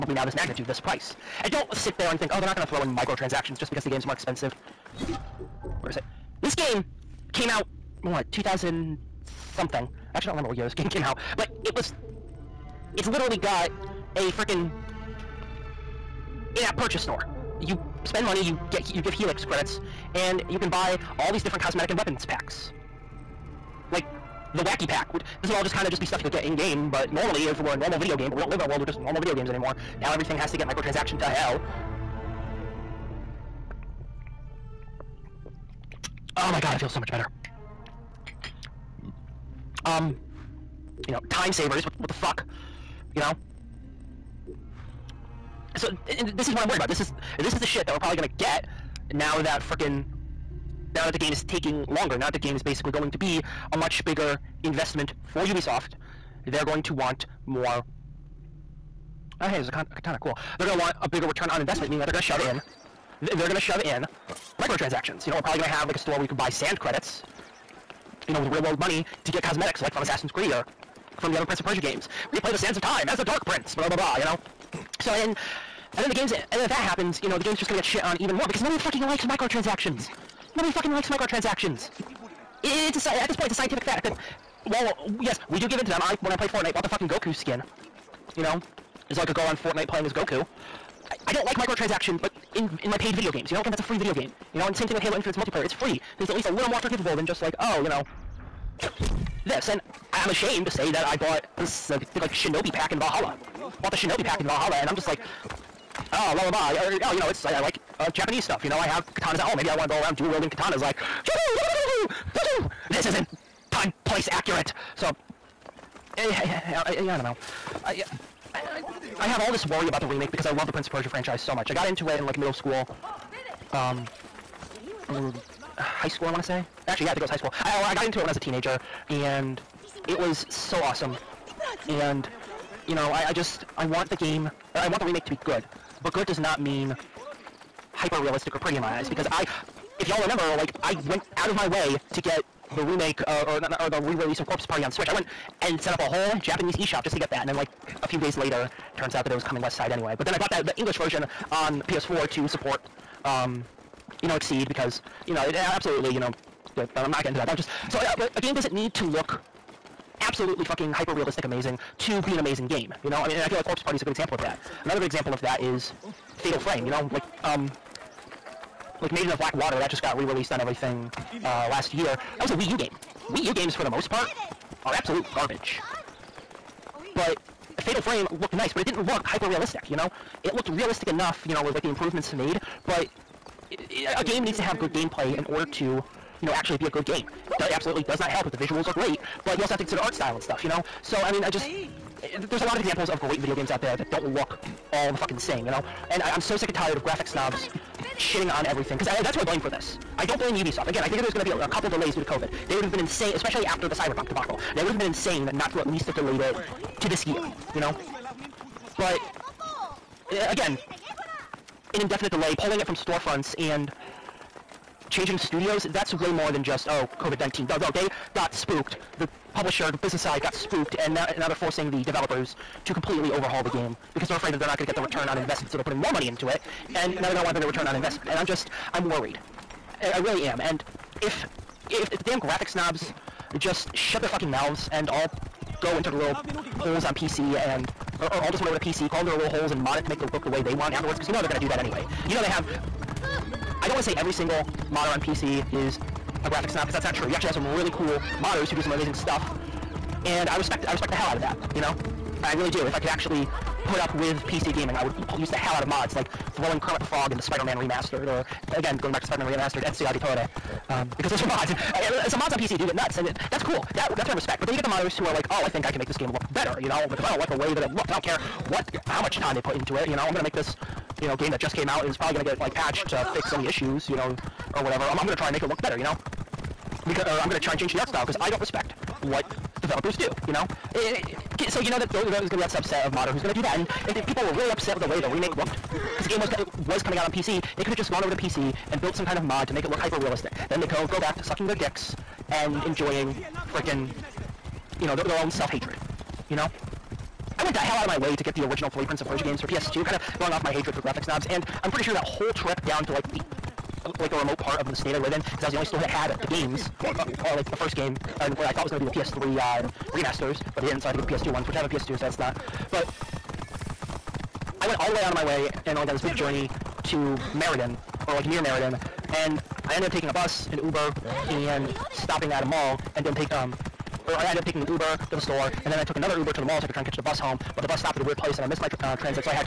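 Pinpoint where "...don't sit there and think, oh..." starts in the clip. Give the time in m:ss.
0:01.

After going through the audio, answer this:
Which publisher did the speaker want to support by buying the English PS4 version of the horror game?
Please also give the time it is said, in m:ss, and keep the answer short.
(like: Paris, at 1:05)
XSEED, at 2:34.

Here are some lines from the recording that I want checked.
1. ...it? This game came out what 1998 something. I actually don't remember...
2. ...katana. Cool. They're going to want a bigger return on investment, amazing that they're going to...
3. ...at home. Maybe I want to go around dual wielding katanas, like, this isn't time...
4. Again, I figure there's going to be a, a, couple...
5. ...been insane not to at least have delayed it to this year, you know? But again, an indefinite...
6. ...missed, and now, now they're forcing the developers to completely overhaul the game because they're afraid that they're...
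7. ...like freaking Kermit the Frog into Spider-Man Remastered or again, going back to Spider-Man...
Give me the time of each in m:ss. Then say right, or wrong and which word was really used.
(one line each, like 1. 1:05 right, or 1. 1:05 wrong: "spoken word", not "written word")
1. 0:05 wrong: "2000", not "1998"
2. 0:59 wrong: "meaning", not "amazing"
3. 1:49 right
4. 3:20 right
5. 3:24 right
6. 3:40 wrong: "spooked", not "missed"
7. 4:16 wrong: "throwing", not "freaking".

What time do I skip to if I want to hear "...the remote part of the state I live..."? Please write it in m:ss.
5:04.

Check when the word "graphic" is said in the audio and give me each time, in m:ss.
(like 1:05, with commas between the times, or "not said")
3:17, 3:52, 4:06, 5:01.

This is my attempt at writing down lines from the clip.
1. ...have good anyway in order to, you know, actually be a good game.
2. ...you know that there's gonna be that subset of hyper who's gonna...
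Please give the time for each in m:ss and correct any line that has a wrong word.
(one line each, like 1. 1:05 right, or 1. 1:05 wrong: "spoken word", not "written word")
1. 3:04 wrong: "gameplay", not "anyway"
2. 4:41 wrong: "modder", not "hyper".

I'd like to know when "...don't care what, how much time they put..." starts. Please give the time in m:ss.
4:28.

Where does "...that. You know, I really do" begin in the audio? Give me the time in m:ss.
4:11.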